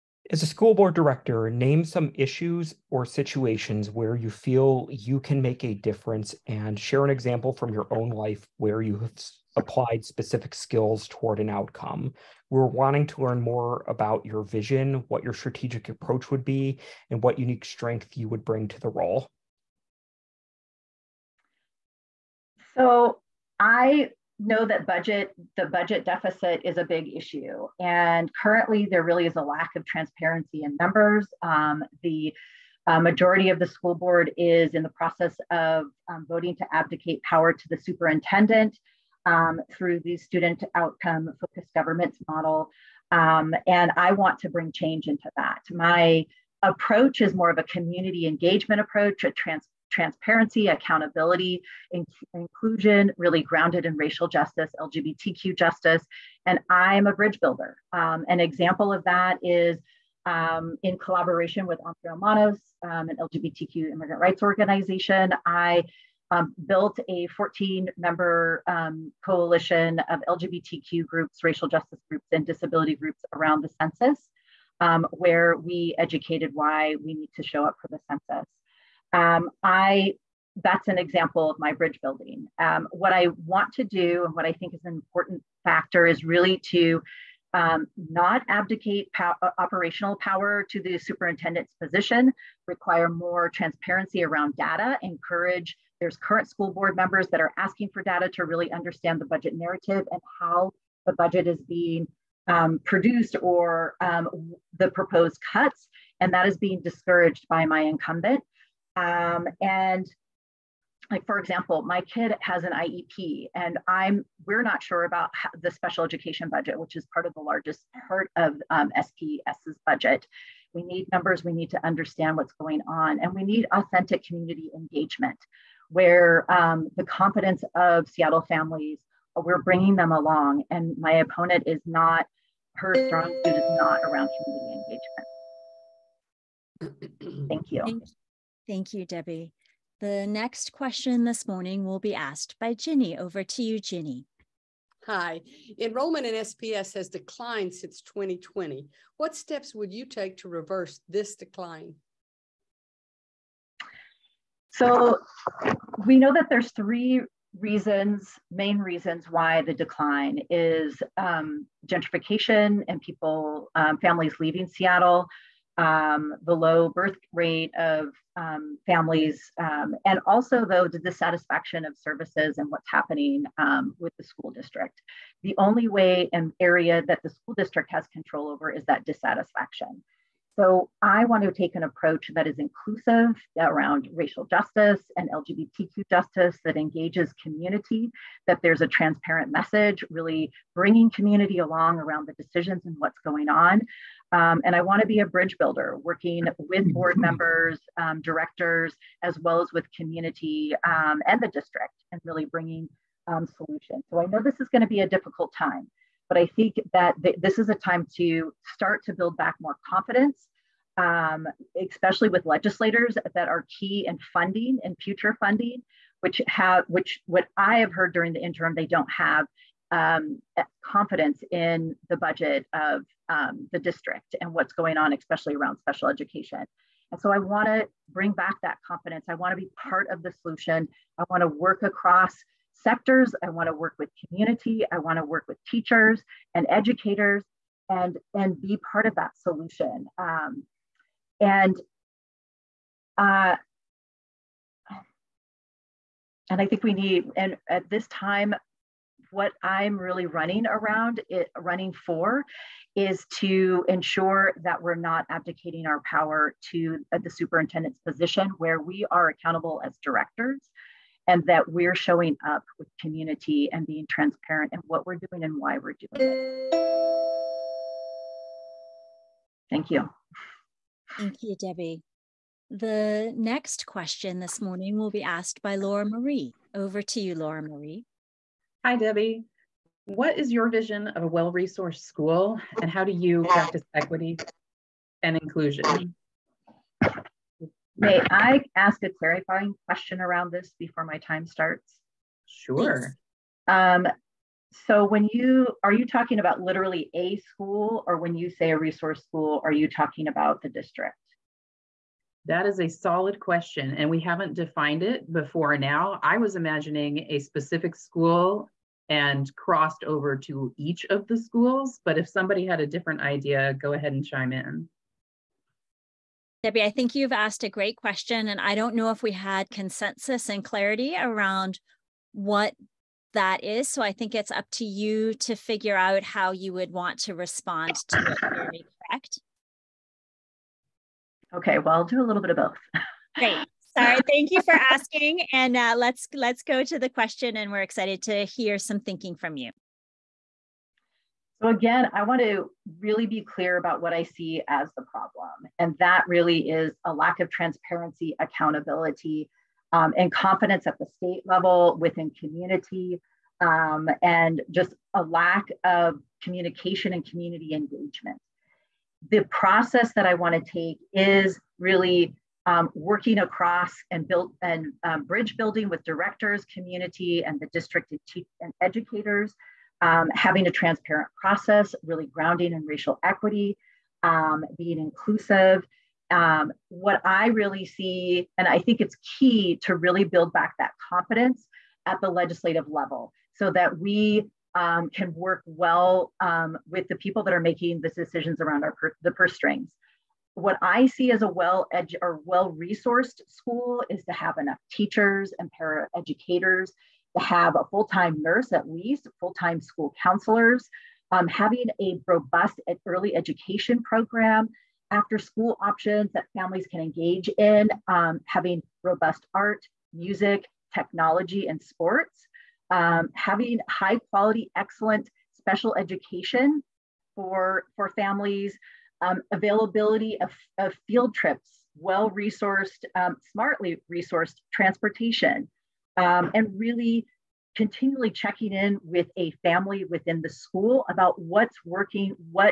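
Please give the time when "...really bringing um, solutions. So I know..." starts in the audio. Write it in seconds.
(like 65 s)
202 s.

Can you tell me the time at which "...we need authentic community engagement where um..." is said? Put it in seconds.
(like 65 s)
123 s.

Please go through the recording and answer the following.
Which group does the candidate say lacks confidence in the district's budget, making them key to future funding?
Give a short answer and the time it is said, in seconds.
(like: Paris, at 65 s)
legislators, at 212 s.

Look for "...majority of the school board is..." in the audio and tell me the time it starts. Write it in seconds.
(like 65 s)
33 s.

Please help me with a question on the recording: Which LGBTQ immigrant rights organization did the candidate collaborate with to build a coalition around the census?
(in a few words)
Entre Hermanos.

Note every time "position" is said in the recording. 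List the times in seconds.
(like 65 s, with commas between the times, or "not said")
91 s, 258 s.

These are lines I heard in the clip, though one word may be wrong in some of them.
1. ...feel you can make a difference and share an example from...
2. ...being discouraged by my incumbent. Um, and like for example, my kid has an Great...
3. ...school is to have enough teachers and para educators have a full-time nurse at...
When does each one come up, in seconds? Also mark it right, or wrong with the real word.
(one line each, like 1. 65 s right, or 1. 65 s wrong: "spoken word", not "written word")
1. 4 s right
2. 106 s wrong: "IEP", not "Great"
3. 393 s right.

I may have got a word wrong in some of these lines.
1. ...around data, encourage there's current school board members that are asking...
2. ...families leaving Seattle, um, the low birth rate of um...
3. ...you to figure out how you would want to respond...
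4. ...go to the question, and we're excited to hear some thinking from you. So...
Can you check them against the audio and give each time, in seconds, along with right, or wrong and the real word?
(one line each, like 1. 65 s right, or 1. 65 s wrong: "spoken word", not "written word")
1. 94 s right
2. 163 s right
3. 324 s right
4. 336 s right.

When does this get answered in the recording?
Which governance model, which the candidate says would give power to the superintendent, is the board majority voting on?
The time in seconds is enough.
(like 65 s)
40 s.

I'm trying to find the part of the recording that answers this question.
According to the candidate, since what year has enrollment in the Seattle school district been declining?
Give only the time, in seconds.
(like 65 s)
148 s.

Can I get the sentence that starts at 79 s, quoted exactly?
Um, I that's an example of my bridge building.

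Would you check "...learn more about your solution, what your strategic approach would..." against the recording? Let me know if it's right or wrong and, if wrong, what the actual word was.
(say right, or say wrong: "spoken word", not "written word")
wrong: "vision", not "solution".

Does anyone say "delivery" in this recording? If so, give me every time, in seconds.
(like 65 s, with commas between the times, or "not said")
not said.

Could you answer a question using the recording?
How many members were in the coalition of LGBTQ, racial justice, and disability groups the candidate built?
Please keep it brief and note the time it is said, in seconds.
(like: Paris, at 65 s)
14, at 67 s.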